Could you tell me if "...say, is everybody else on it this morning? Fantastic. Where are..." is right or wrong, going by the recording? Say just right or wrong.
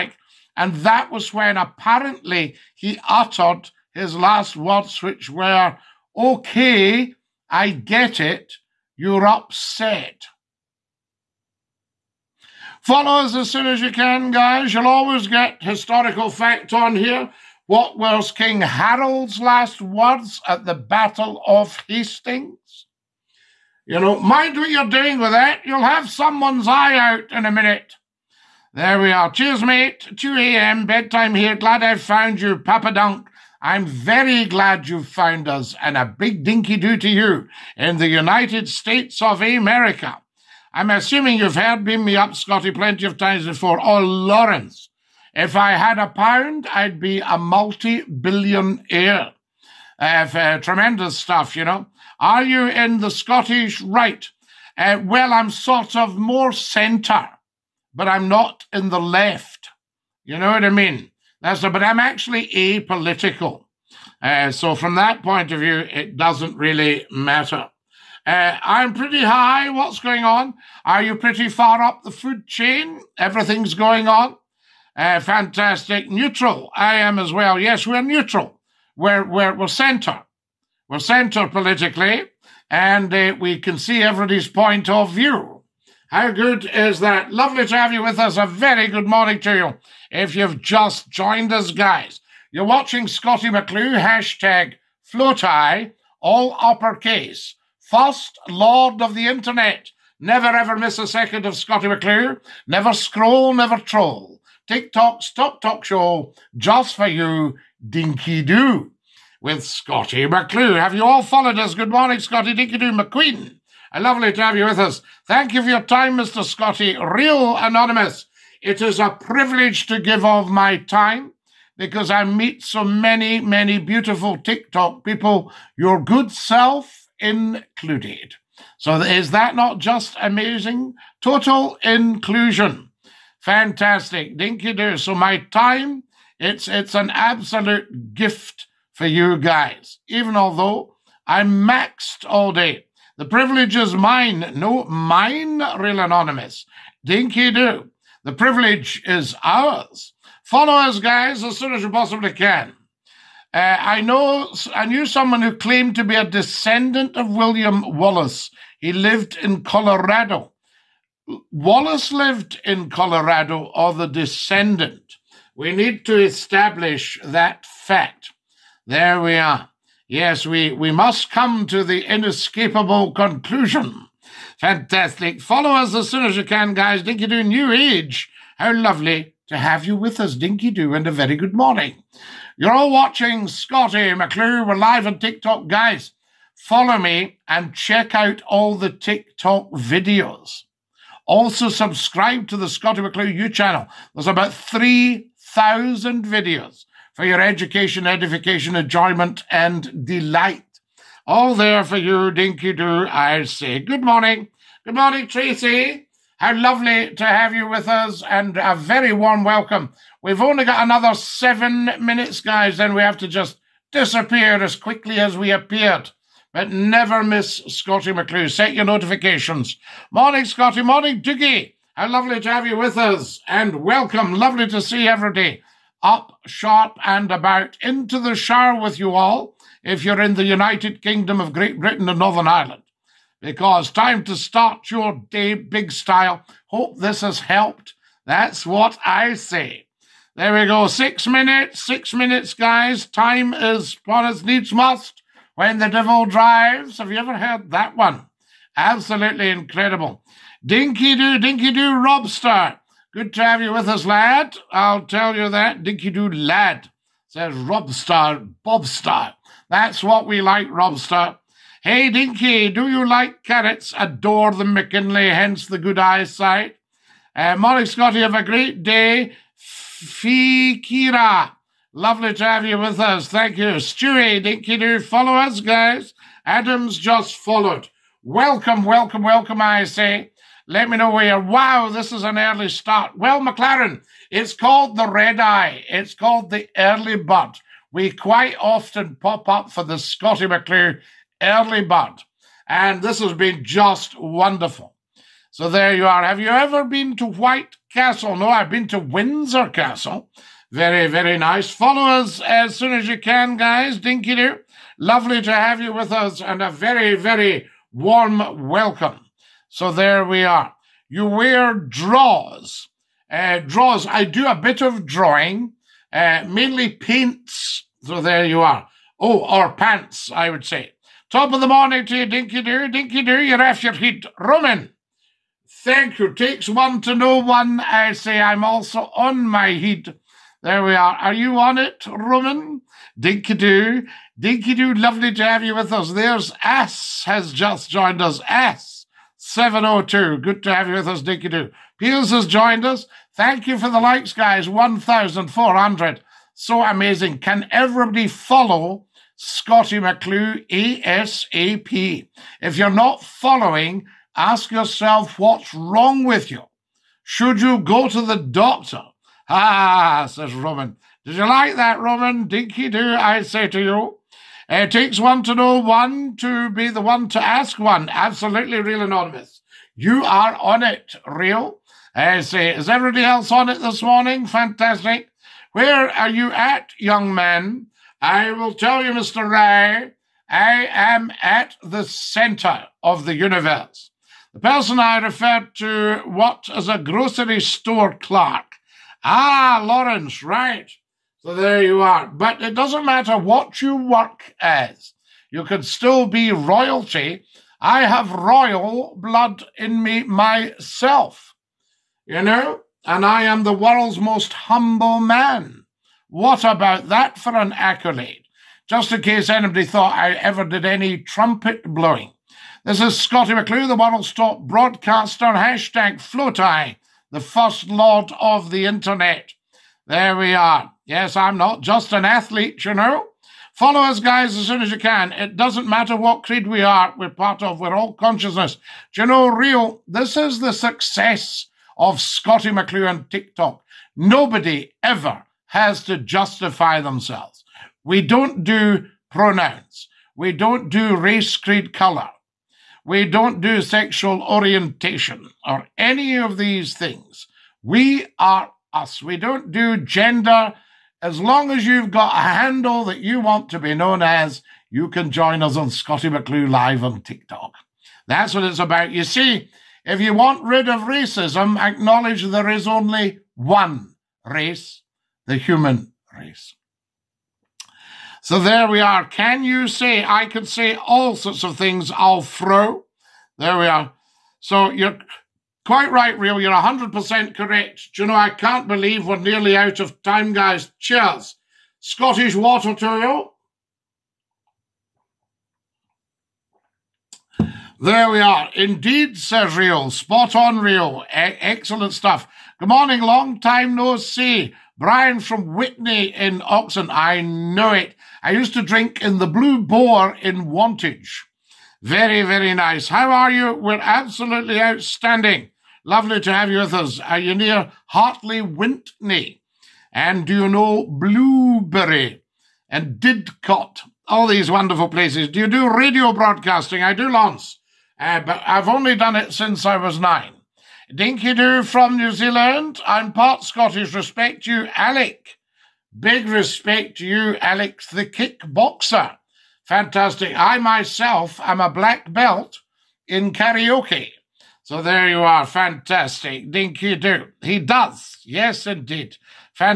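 right.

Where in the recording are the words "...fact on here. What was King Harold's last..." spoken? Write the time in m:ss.
0:16.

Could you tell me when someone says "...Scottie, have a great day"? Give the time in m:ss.
4:27.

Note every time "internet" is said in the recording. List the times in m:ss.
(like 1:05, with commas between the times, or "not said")
1:39, 6:58.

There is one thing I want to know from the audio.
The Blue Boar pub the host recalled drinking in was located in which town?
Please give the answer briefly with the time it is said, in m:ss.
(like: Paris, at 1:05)
Wantage, at 8:20.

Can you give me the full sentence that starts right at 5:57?
Should you go to the doctor?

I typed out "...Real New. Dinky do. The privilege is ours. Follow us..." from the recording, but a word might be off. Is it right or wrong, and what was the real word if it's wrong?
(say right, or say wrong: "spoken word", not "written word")
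wrong: "Anonymous", not "New".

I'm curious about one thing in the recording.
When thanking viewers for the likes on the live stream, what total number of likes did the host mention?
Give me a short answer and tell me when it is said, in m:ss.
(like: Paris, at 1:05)
1,400, at 5:44.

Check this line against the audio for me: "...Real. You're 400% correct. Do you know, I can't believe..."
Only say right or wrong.
wrong.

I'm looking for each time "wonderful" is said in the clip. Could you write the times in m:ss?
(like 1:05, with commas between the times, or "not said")
4:54, 8:34.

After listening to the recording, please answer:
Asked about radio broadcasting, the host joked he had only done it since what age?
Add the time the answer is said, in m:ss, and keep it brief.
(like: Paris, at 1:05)
9, at 8:40.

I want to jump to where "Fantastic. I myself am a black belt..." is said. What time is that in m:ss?
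8:49.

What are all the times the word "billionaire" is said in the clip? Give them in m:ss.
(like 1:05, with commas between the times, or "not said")
0:48.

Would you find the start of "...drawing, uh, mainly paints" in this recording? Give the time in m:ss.
5:15.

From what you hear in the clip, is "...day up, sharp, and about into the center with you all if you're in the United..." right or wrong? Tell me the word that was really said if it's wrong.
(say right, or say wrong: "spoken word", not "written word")
wrong: "shower", not "center".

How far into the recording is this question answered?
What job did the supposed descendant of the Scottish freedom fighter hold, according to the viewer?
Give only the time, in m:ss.
6:26.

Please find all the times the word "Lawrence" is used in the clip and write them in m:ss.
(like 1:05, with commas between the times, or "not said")
0:44, 6:29.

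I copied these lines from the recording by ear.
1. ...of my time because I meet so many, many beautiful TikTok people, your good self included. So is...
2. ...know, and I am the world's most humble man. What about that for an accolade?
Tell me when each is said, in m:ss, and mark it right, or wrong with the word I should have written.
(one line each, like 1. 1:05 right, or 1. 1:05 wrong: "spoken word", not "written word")
1. 2:00 right
2. 6:42 right.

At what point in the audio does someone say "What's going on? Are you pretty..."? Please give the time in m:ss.
1:09.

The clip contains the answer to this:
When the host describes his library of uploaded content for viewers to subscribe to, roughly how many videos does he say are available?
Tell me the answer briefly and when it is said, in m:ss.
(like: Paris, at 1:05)
3,000, at 3:14.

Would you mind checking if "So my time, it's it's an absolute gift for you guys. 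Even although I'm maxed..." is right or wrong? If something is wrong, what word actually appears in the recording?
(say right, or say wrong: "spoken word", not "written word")
right.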